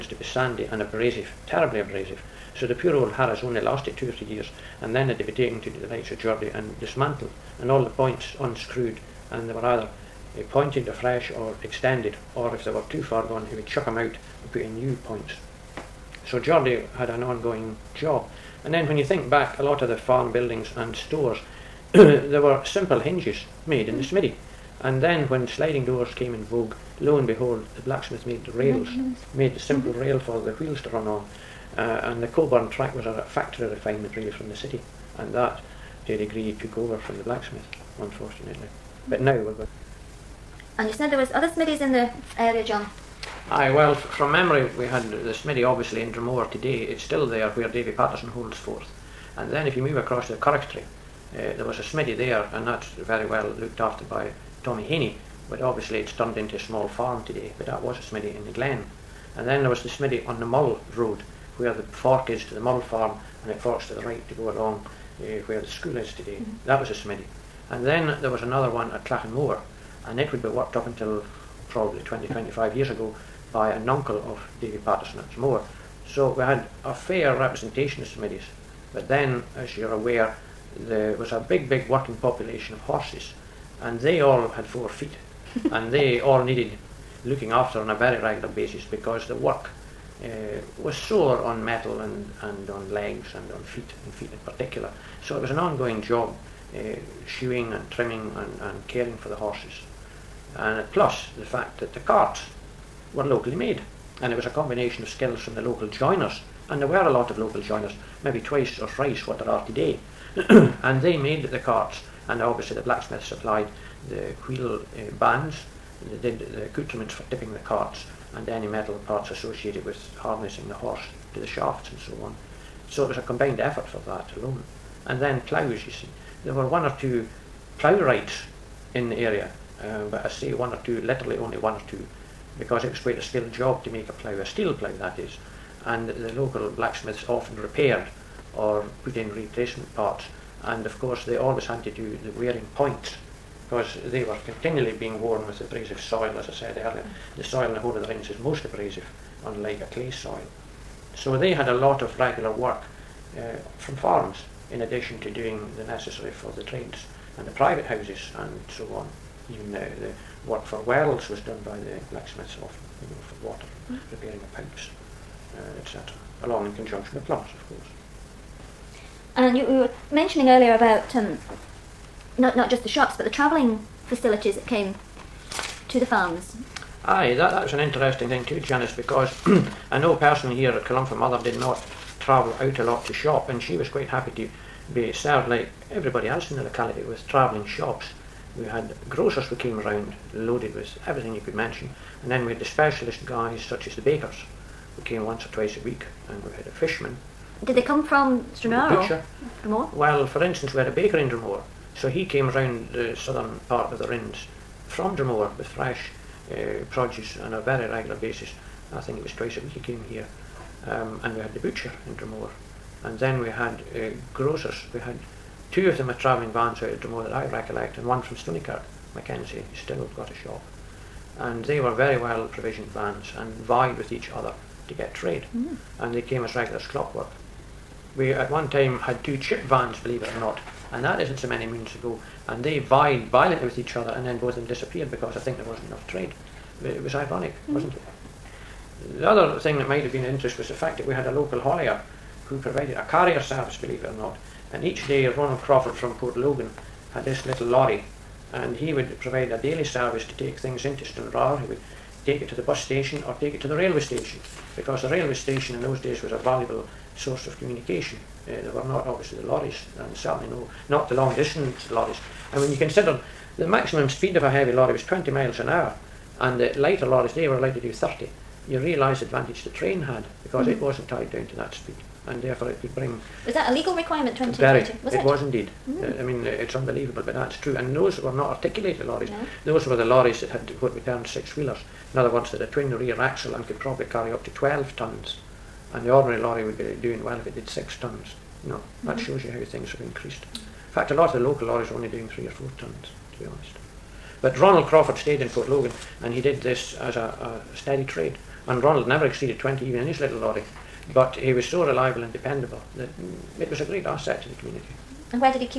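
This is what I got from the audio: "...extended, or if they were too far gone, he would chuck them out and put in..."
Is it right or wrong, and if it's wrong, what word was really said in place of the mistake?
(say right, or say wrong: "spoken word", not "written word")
right.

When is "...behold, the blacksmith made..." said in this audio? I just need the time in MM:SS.
00:27.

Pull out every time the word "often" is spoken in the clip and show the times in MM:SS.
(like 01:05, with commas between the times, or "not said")
02:17, 02:42.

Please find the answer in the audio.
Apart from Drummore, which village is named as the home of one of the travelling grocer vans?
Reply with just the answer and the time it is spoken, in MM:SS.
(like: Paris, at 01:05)
Stoneykirk, at 03:38.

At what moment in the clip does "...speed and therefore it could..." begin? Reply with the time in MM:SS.
04:31.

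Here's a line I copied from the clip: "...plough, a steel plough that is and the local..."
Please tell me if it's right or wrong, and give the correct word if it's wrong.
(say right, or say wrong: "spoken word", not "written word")
right.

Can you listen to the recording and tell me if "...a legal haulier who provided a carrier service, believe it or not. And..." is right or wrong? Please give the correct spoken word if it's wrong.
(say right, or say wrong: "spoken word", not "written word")
wrong: "local", not "legal".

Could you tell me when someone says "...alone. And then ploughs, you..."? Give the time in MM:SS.
02:04.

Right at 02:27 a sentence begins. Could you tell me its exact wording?
The soil in the whole of the range is most abrasive unlike a clay soil.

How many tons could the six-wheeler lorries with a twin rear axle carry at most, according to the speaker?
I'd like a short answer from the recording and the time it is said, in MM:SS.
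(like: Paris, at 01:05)
12 tons, at 04:44.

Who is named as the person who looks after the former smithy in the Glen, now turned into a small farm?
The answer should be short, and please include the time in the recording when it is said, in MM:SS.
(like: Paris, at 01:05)
Tommy Haney, at 00:54.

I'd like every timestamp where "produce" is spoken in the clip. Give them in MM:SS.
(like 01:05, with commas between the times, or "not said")
03:26.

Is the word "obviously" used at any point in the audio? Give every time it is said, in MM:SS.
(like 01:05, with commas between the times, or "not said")
00:45, 00:55, 01:52, 04:19.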